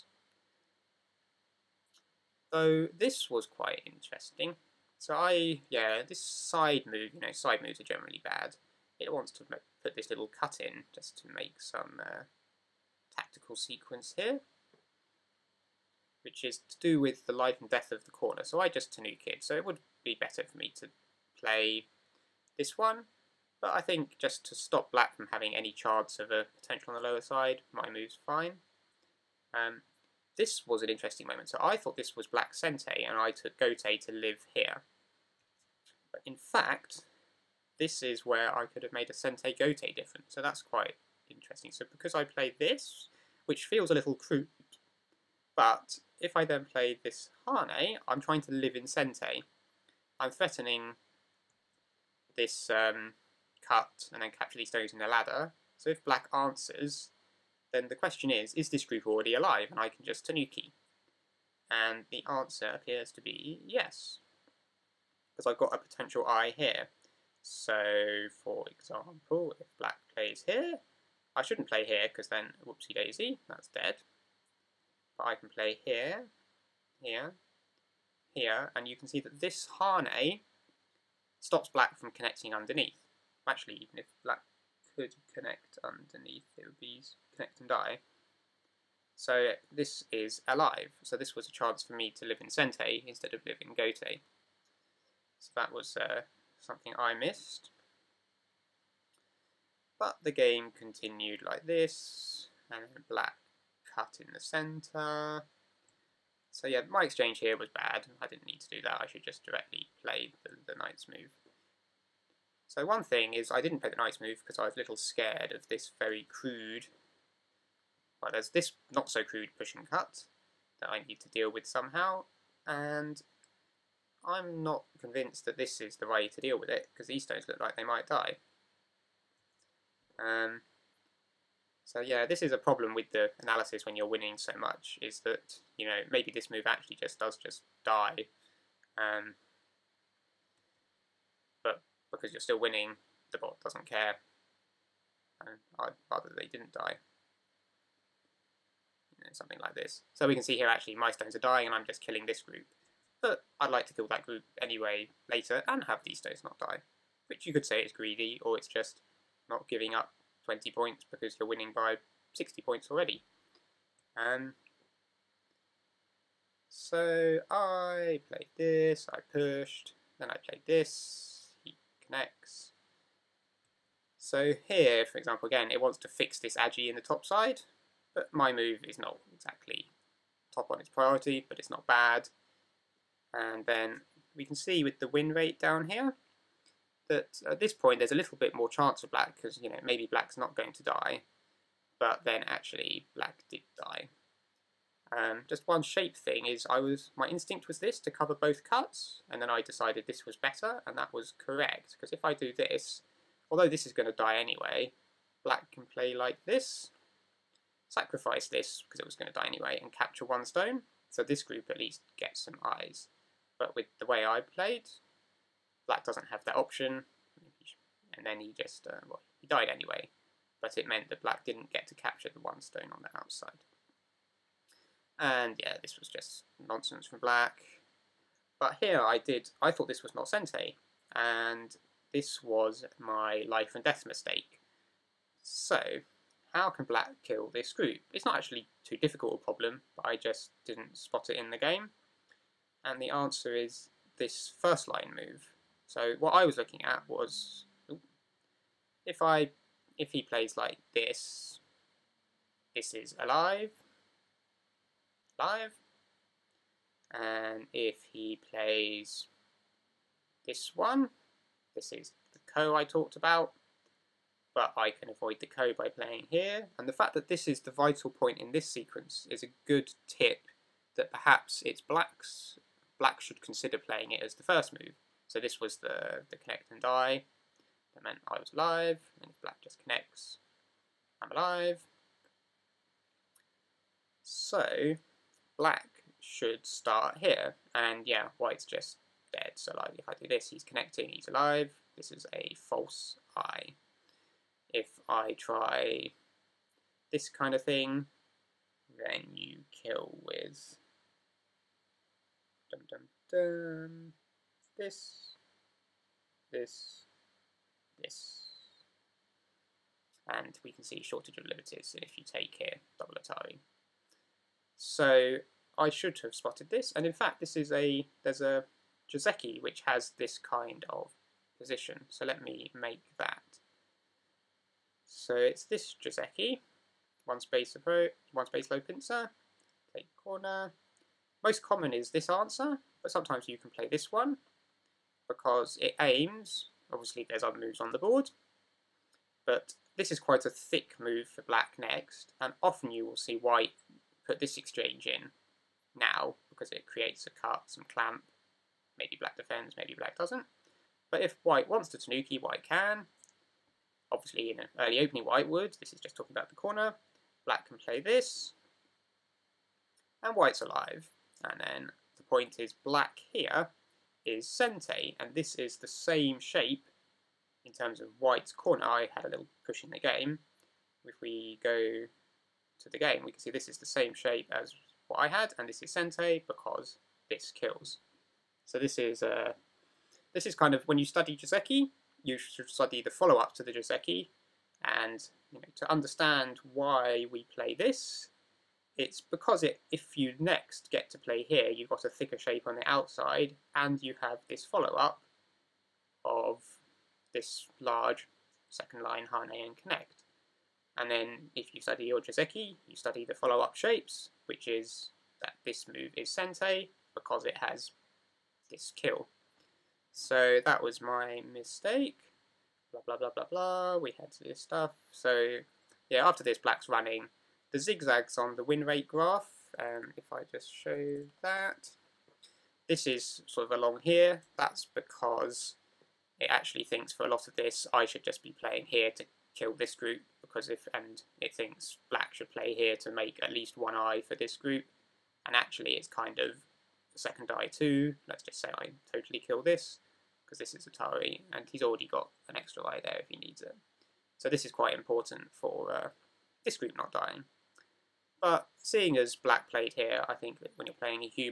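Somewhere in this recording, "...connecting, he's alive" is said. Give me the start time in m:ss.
4:50.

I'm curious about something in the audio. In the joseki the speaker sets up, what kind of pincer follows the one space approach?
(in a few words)
One space low pincer.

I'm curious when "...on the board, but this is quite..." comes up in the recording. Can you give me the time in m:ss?
5:37.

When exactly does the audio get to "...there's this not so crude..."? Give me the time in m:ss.
1:58.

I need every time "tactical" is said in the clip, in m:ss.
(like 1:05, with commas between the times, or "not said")
0:13.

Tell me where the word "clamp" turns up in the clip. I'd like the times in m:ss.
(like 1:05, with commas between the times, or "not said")
5:47.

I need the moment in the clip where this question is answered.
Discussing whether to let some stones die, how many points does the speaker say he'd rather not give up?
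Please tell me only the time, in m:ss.
2:40.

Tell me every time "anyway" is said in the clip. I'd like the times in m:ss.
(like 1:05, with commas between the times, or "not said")
2:34, 3:24, 3:29, 3:39.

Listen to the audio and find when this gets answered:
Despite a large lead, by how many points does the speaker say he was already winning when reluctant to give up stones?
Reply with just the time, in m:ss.
2:42.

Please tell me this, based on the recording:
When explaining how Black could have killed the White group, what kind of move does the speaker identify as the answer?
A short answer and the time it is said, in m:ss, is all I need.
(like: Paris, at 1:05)
First line move, at 4:04.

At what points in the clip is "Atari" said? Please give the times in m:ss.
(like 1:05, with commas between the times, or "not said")
5:13, 7:20.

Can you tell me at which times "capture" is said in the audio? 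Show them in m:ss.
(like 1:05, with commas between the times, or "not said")
0:54, 3:29, 3:41.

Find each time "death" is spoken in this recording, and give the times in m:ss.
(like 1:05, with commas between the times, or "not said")
0:17, 3:53.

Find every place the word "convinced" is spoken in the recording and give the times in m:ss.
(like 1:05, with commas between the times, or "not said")
2:05.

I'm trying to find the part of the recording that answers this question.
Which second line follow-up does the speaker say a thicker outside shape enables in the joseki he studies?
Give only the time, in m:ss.
6:38.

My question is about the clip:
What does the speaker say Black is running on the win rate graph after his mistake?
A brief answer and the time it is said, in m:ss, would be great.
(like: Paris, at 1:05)
The zigzags, at 6:57.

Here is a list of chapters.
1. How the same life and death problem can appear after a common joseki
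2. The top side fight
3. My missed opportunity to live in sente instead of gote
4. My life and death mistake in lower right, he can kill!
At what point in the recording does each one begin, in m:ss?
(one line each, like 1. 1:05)
1. 5:15
2. 3:01
3. 0:28
4. 3:46.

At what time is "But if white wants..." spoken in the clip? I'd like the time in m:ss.
5:51.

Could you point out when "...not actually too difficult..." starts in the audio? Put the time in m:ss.
3:58.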